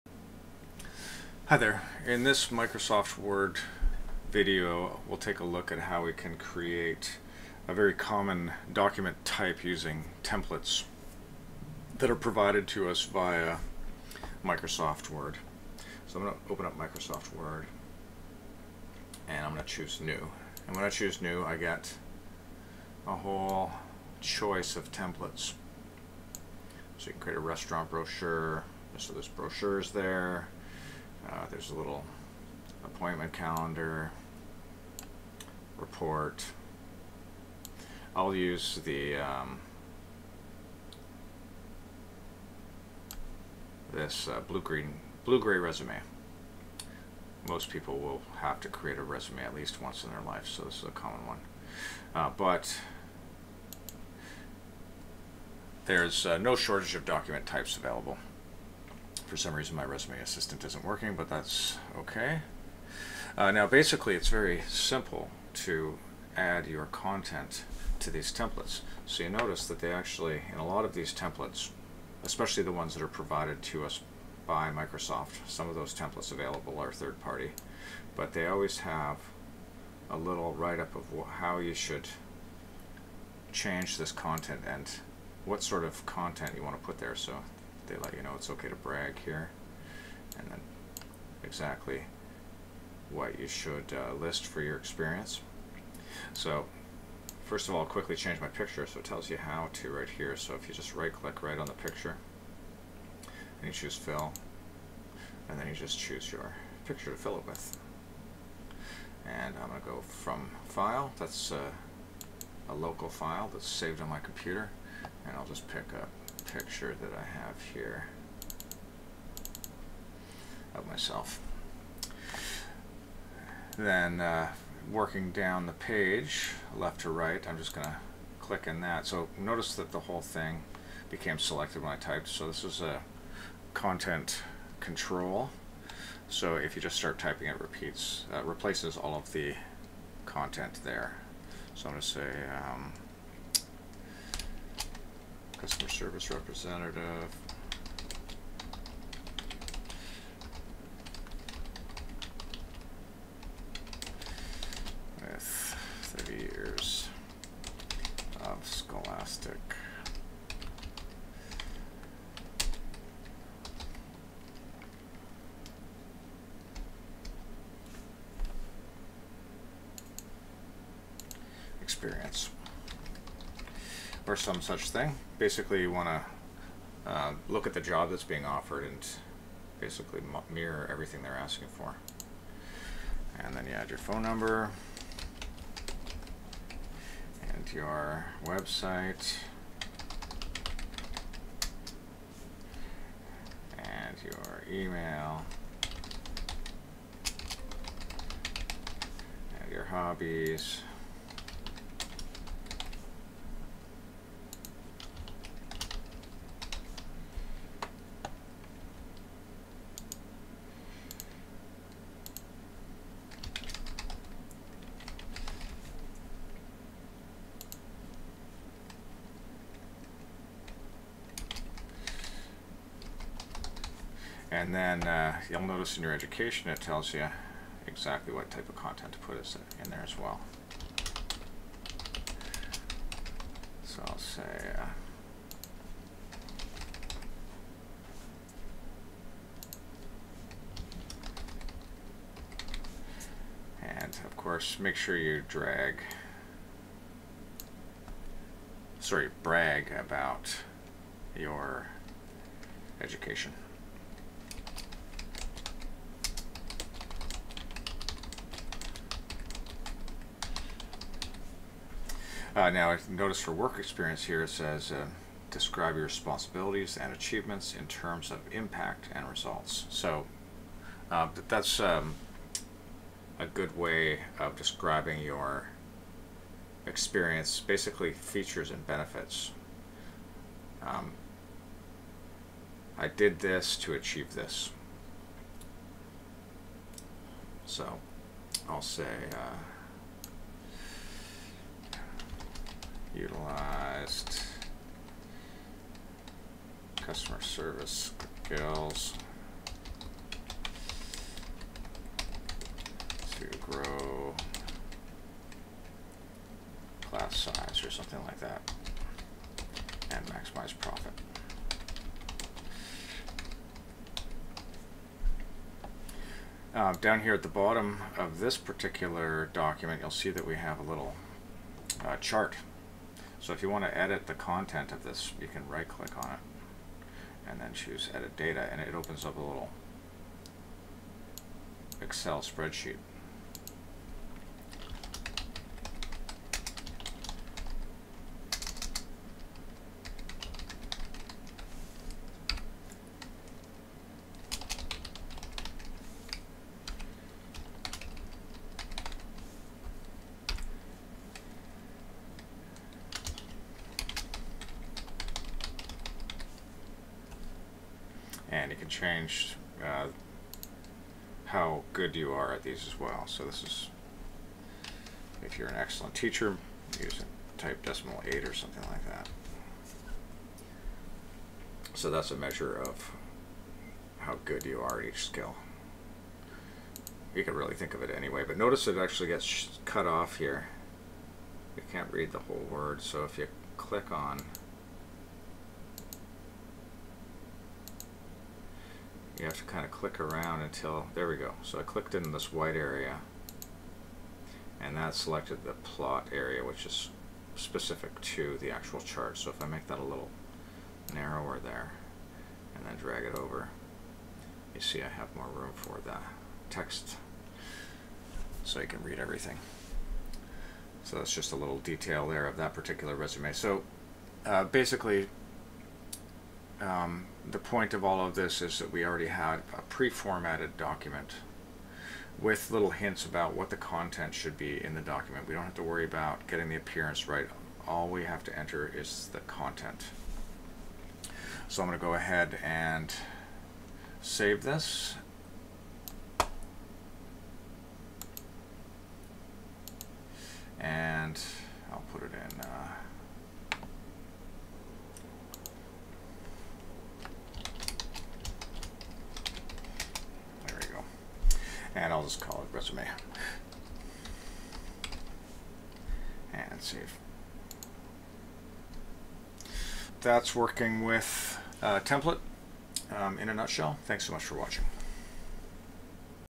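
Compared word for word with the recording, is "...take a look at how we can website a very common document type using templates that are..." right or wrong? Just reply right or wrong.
wrong.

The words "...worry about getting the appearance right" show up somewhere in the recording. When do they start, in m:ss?
7:05.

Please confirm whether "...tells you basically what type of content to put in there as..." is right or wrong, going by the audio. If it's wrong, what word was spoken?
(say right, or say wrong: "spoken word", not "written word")
wrong: "exactly", not "basically".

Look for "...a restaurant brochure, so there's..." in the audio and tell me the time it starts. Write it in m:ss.
0:27.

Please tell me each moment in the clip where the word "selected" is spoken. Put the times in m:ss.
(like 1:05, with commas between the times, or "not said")
2:11, 6:35.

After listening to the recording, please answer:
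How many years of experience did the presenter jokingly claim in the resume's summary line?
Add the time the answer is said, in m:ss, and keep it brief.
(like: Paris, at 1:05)
30, at 2:36.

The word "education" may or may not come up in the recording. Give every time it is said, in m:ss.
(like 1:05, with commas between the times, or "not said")
3:46, 4:13.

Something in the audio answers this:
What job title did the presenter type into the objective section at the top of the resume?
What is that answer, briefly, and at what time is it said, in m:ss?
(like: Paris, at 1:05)
customer service representative, at 2:25.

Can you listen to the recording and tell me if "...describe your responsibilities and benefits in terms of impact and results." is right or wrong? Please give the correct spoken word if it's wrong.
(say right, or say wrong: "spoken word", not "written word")
wrong: "achievements", not "benefits".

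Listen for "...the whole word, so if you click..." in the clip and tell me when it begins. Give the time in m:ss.
6:22.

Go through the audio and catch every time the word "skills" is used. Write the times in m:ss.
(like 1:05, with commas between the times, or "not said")
4:58, 6:15.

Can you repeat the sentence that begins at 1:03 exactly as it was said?
Uh, now basically it's very simple to add your content to these templates.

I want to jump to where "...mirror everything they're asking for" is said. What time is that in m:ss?
3:00.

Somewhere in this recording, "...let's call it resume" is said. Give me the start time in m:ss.
7:32.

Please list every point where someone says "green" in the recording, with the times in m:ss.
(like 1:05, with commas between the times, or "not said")
0:44.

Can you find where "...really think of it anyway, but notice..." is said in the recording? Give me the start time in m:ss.
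6:17.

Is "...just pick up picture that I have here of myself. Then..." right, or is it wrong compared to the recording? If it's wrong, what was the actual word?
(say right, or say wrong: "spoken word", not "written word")
right.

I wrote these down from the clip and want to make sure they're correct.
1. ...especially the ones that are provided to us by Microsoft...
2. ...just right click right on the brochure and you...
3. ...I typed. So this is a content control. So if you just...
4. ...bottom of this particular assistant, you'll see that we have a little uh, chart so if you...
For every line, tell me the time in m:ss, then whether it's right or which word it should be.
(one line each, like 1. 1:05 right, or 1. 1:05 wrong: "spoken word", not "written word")
1. 1:12 right
2. 1:40 wrong: "picture", not "brochure"
3. 2:11 right
4. 5:17 wrong: "document", not "assistant".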